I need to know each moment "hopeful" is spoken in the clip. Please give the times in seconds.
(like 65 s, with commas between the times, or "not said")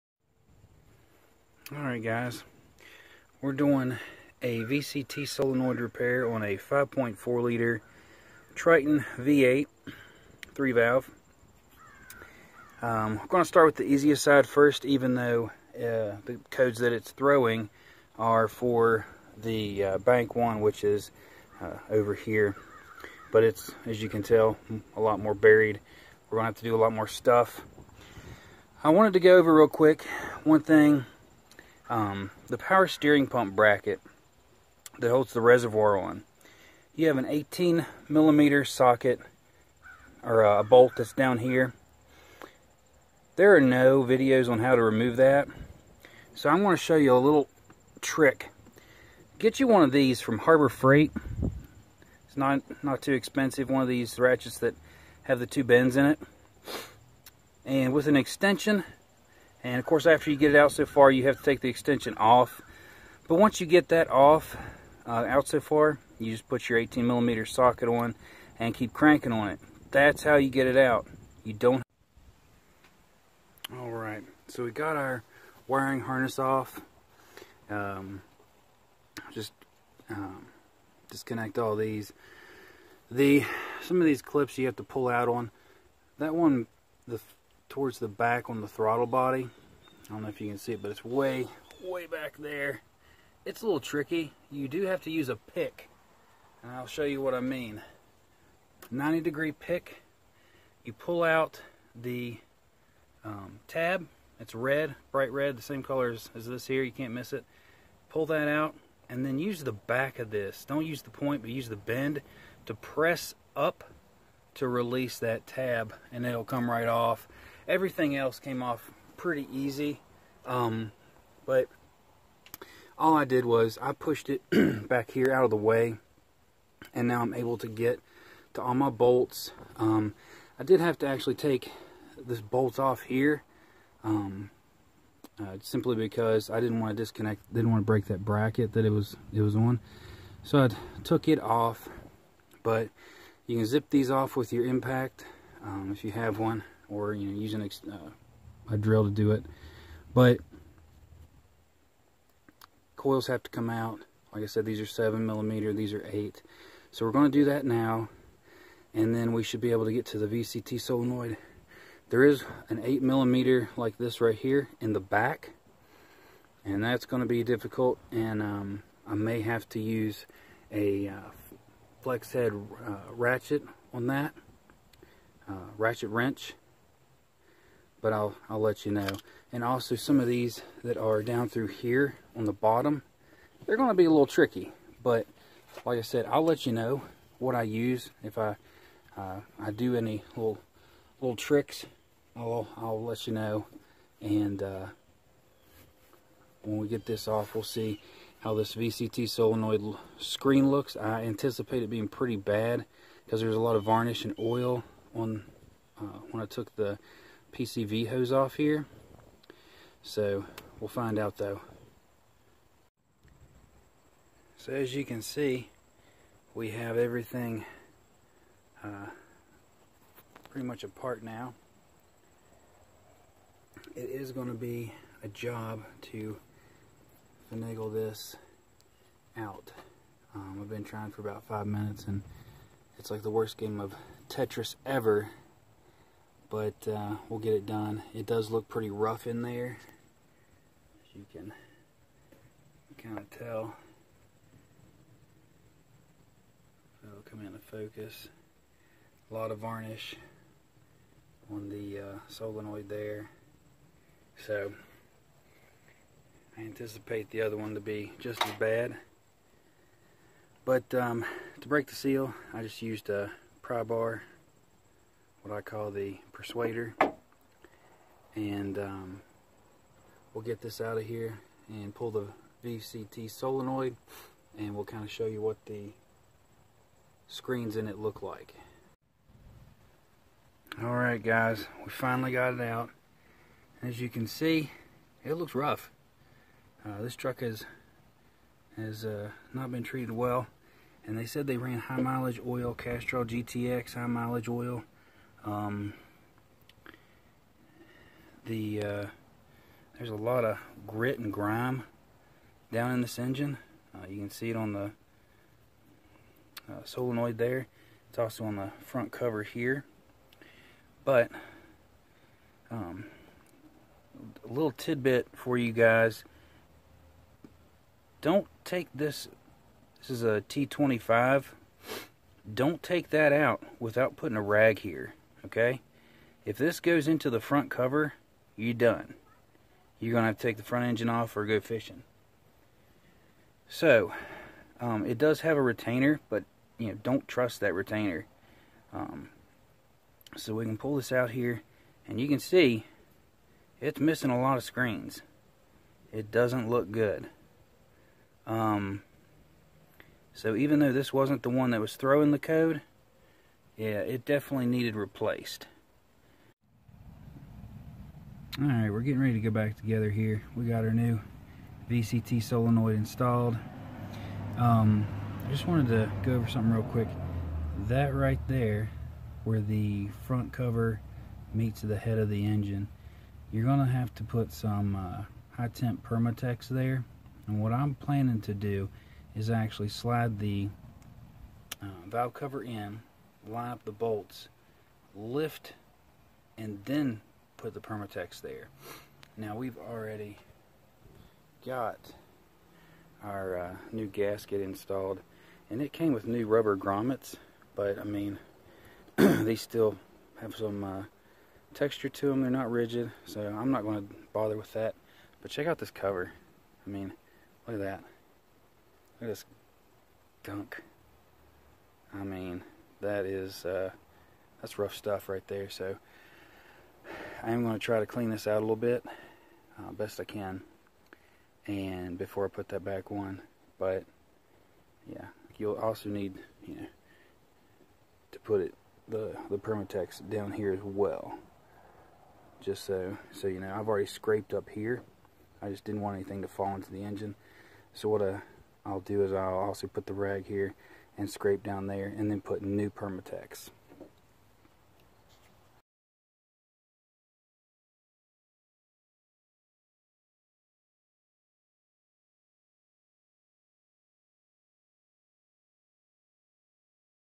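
not said.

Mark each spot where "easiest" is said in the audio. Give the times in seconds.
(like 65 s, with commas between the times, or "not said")
13 s.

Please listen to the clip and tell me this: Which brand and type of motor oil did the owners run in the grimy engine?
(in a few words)
Castrol GTX high mileage.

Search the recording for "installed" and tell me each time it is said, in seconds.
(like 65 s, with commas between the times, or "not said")
362 s, 394 s.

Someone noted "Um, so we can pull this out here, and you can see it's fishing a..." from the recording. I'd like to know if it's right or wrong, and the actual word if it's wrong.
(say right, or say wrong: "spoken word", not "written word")
wrong: "missing", not "fishing".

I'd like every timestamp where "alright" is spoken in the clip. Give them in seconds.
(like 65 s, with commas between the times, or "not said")
1 s, 280 s, 358 s.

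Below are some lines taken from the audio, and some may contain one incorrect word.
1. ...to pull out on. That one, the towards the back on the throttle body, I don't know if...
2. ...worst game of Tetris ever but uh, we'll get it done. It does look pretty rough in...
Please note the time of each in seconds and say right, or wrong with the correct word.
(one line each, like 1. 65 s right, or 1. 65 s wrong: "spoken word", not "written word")
1. 84 s right
2. 233 s right.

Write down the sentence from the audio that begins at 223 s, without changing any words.
It is going to be a job to finagle this out.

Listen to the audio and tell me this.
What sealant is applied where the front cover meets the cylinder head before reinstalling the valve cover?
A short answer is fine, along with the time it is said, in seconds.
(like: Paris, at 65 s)
high temp Permatex, at 375 s.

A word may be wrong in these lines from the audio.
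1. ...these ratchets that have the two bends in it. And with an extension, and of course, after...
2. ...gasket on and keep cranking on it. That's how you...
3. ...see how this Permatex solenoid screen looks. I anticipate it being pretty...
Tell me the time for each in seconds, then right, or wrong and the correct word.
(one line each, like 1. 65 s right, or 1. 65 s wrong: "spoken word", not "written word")
1. 53 s right
2. 67 s wrong: "socket", not "gasket"
3. 197 s wrong: "VCT", not "Permatex".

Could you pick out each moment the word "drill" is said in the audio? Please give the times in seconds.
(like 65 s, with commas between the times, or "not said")
148 s.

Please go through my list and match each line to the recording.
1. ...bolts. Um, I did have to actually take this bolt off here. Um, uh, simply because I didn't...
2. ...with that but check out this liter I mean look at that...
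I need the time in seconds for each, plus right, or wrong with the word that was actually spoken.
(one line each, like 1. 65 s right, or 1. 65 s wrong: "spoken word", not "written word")
1. 128 s right
2. 404 s wrong: "cover", not "liter".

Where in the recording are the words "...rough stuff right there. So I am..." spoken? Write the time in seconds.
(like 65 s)
414 s.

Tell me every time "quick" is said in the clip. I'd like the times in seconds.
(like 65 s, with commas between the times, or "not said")
29 s, 366 s.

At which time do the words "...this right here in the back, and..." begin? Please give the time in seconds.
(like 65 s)
163 s.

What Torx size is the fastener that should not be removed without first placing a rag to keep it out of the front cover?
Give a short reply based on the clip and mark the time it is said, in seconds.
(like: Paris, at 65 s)
T25, at 320 s.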